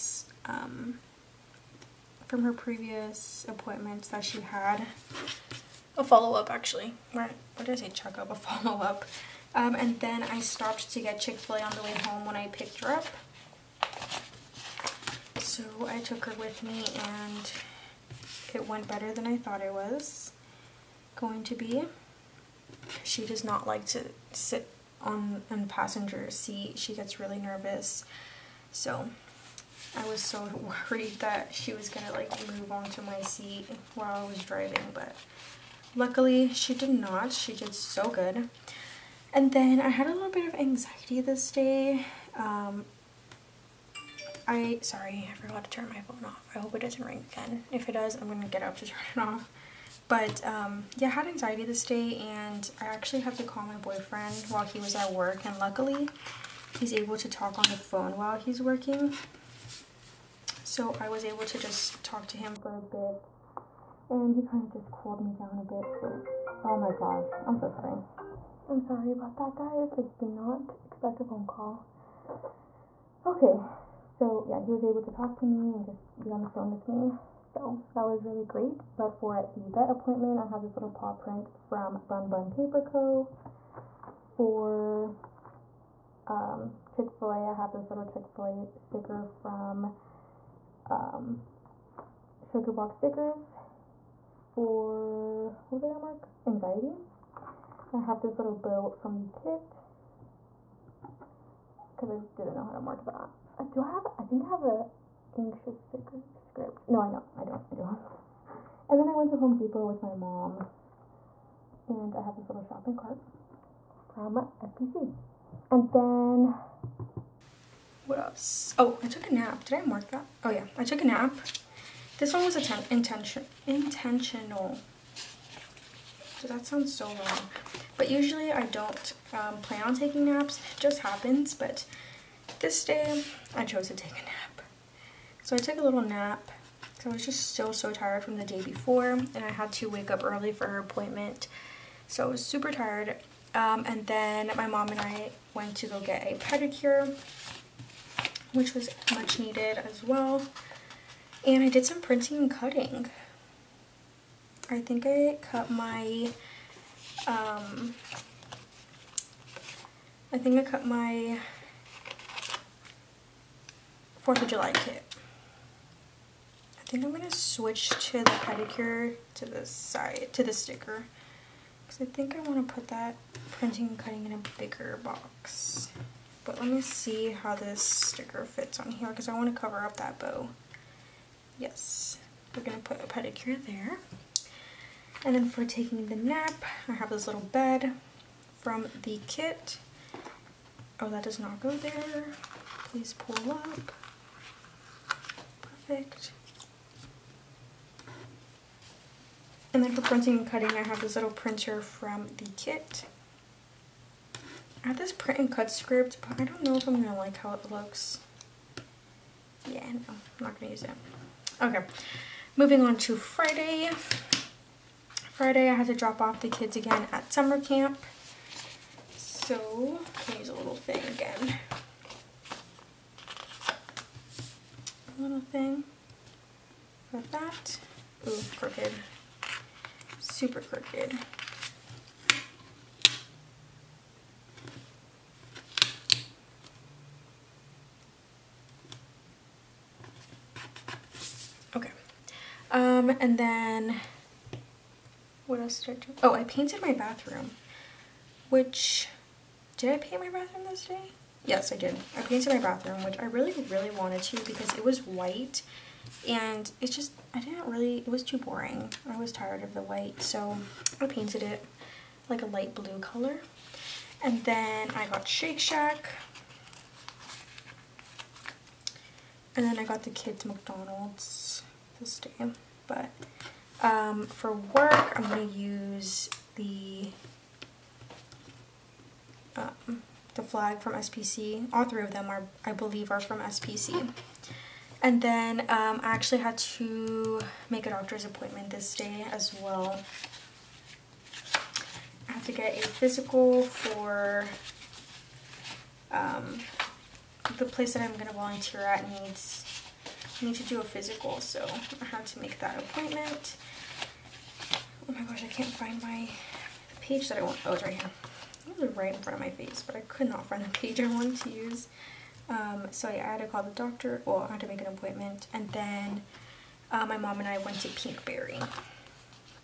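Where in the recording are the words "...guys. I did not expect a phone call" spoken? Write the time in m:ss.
1:09.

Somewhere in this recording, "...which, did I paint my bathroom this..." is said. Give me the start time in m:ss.
4:08.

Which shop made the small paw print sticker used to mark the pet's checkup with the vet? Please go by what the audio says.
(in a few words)
Bun Bun Paper Co.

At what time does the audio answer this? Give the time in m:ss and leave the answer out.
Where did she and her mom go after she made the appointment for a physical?
5:17.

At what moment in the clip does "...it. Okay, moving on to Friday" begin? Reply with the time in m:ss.
3:30.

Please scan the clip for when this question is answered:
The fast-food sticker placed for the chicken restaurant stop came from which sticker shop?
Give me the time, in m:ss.
1:32.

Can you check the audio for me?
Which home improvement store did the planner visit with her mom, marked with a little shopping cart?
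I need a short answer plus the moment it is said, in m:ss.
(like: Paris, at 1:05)
Home Depot, at 1:49.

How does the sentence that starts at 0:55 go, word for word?
And luckily, he's able to talk on the phone while he's working.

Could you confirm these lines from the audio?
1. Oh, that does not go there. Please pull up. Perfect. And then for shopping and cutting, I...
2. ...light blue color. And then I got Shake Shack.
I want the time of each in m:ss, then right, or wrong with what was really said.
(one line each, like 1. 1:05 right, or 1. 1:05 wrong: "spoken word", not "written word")
1. 3:10 wrong: "printing", not "shopping"
2. 4:22 right.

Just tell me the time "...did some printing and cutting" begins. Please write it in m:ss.
2:31.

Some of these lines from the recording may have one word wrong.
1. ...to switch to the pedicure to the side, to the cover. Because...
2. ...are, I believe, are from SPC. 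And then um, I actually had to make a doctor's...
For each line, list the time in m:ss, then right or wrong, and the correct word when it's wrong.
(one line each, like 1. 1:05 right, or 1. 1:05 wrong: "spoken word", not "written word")
1. 2:47 wrong: "sticker", not "cover"
2. 4:42 right.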